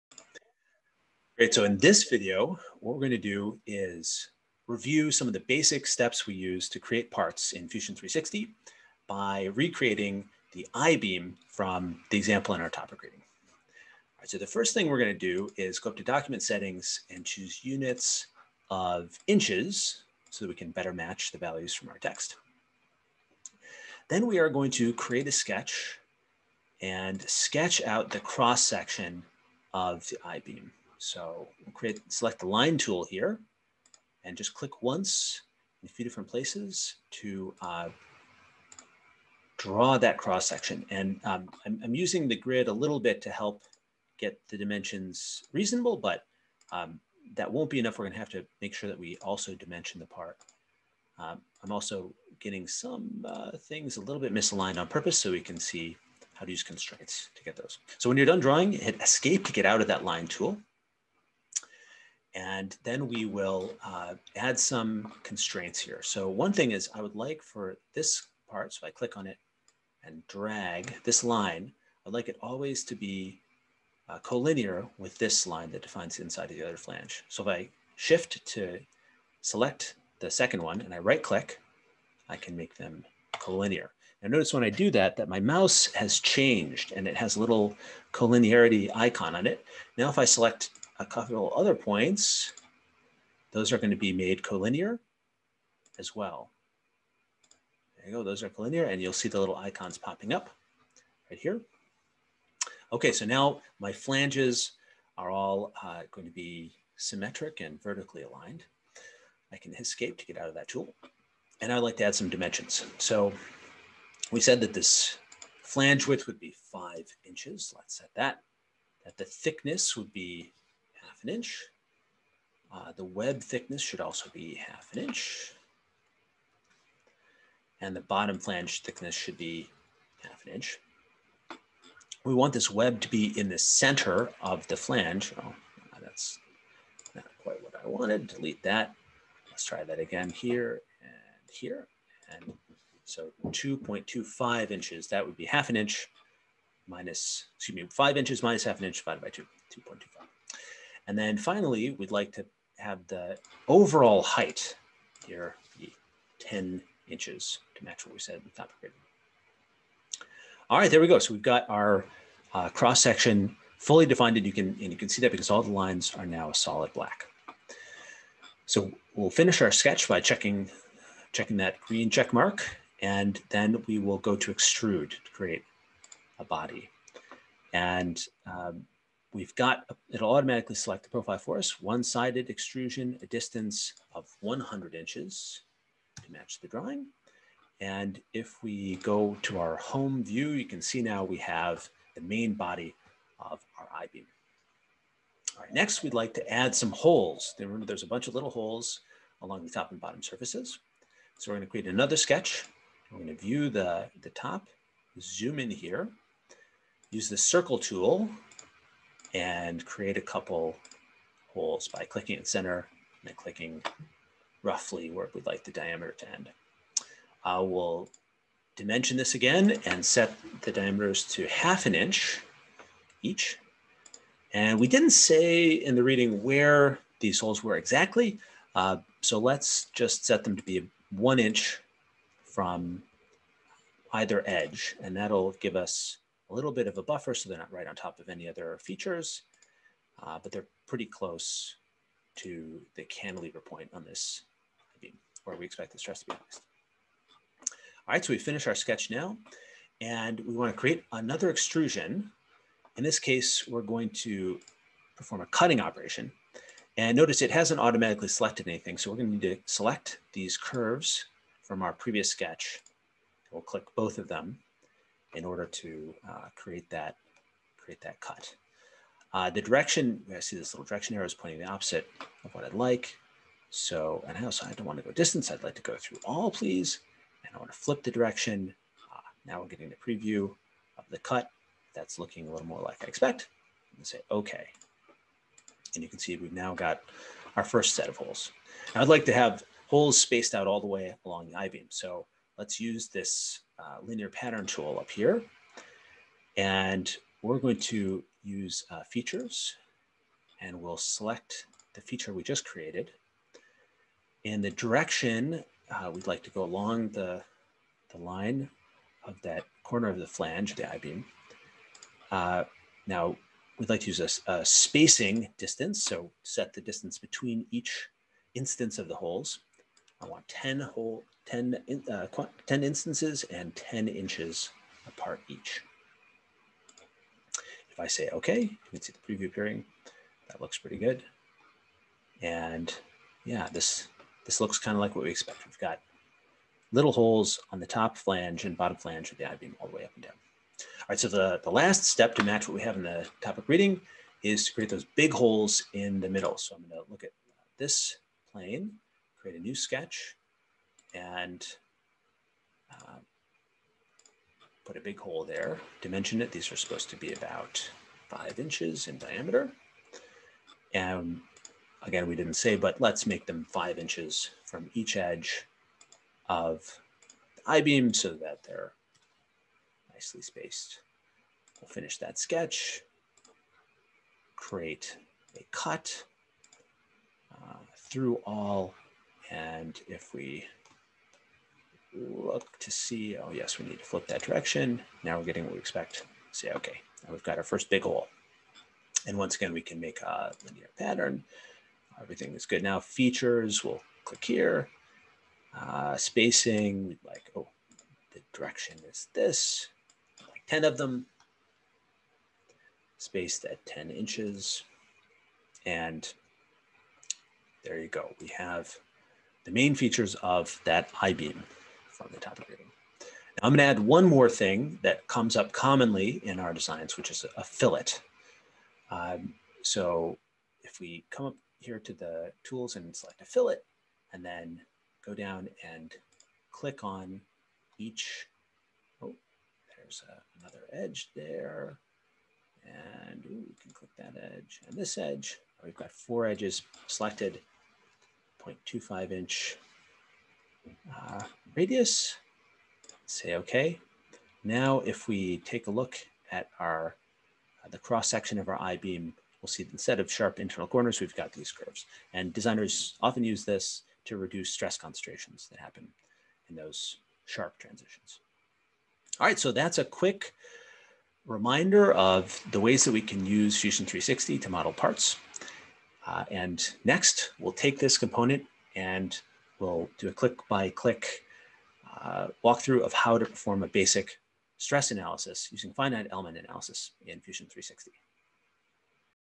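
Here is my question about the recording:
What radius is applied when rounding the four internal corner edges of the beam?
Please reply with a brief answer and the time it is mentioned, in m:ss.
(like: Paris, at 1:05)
0.25 inch, at 7:18.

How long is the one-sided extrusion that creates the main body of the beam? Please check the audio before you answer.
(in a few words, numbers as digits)
100 inches.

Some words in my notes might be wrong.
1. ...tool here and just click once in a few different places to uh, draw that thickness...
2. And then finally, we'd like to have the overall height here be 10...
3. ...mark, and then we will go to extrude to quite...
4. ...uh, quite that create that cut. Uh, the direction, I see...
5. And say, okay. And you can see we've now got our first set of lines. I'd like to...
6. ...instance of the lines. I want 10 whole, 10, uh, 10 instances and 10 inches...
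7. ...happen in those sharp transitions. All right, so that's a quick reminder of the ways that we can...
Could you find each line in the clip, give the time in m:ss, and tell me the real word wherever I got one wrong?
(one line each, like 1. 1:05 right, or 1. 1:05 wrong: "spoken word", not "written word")
1. 0:32 wrong: "cross", not "thickness"
2. 2:31 right
3. 2:52 wrong: "create", not "quite"
4. 4:26 wrong: "create", not "quite"
5. 4:43 wrong: "holes", not "lines"
6. 5:18 wrong: "holes", not "lines"
7. 7:35 right.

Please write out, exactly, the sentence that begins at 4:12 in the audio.
In this case, we're going to perform a cutting operation.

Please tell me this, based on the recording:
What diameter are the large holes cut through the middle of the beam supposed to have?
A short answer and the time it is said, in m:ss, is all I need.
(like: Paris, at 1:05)
5 inches, at 5:58.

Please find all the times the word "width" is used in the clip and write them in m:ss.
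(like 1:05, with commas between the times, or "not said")
1:56.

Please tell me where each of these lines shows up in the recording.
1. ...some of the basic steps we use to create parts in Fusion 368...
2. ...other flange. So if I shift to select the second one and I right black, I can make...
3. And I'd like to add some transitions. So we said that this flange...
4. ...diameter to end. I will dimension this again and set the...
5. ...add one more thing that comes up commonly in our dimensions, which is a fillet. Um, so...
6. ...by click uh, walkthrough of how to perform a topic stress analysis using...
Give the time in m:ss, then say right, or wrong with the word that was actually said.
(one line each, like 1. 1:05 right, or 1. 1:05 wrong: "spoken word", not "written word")
1. 0:05 wrong: "360", not "368"
2. 1:16 wrong: "click", not "black"
3. 1:51 wrong: "dimensions", not "transitions"
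4. 3:35 right
5. 6:53 wrong: "designs", not "dimensions"
6. 7:50 wrong: "basic", not "topic".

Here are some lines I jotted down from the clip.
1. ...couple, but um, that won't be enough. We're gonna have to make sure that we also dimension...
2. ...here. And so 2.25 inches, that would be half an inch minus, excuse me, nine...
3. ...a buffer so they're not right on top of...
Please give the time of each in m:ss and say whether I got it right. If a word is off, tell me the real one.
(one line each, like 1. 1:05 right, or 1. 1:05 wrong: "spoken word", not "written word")
1. 0:45 wrong: "reasonable", not "couple"
2. 2:21 wrong: "five", not "nine"
3. 3:56 right.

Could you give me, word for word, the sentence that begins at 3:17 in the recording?
Remember there's a bunch of little holes along the top and bottom surfaces.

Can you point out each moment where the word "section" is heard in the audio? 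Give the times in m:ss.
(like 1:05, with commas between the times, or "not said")
0:28, 0:40, 2:43, 7:28.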